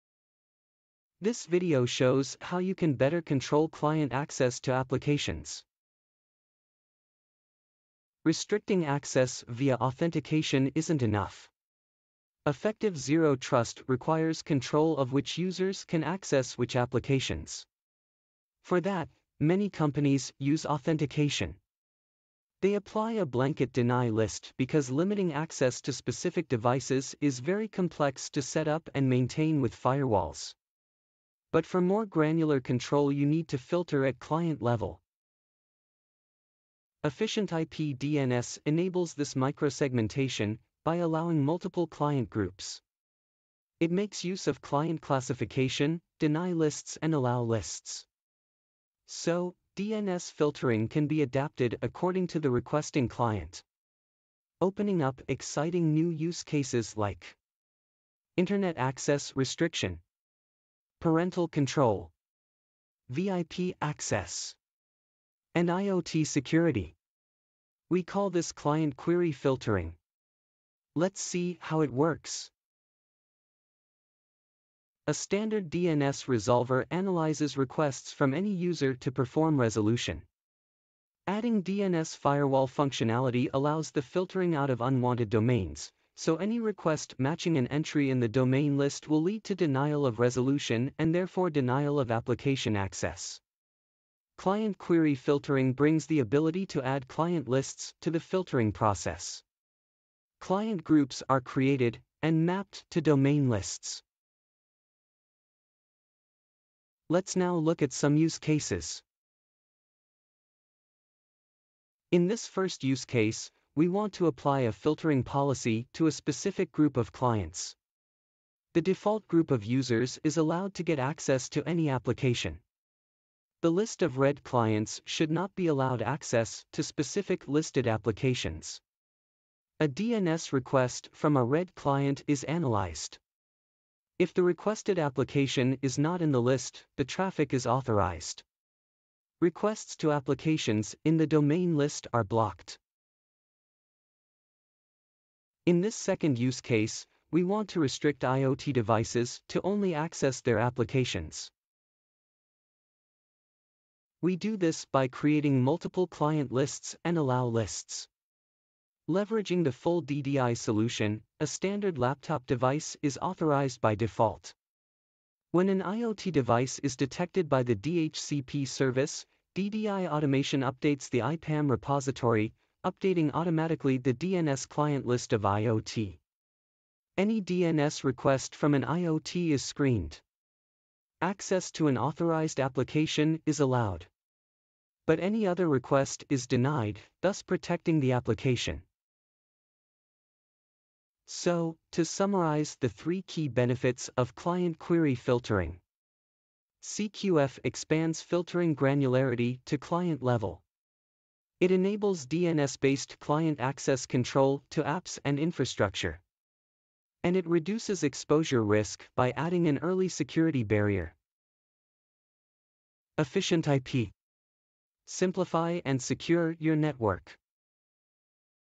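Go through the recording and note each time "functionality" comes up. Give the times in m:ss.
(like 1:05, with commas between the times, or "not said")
1:22.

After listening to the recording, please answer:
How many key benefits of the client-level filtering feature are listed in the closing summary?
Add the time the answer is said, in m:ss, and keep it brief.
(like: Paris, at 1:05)
3, at 3:12.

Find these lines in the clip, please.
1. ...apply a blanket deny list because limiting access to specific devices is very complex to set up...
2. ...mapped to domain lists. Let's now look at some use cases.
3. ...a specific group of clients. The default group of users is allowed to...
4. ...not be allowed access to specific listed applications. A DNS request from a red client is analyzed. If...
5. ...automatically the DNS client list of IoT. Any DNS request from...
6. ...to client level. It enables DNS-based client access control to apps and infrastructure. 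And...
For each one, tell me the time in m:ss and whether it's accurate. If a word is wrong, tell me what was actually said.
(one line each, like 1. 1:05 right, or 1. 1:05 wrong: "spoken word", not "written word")
1. 0:22 right
2. 1:42 right
3. 1:56 right
4. 2:05 right
5. 2:53 right
6. 3:19 right.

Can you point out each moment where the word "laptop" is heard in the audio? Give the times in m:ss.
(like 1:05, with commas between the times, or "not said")
2:41.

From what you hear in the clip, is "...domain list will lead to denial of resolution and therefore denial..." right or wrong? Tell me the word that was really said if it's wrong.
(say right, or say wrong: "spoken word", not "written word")
right.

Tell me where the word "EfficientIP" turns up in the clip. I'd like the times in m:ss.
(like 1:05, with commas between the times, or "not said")
0:37, 3:33.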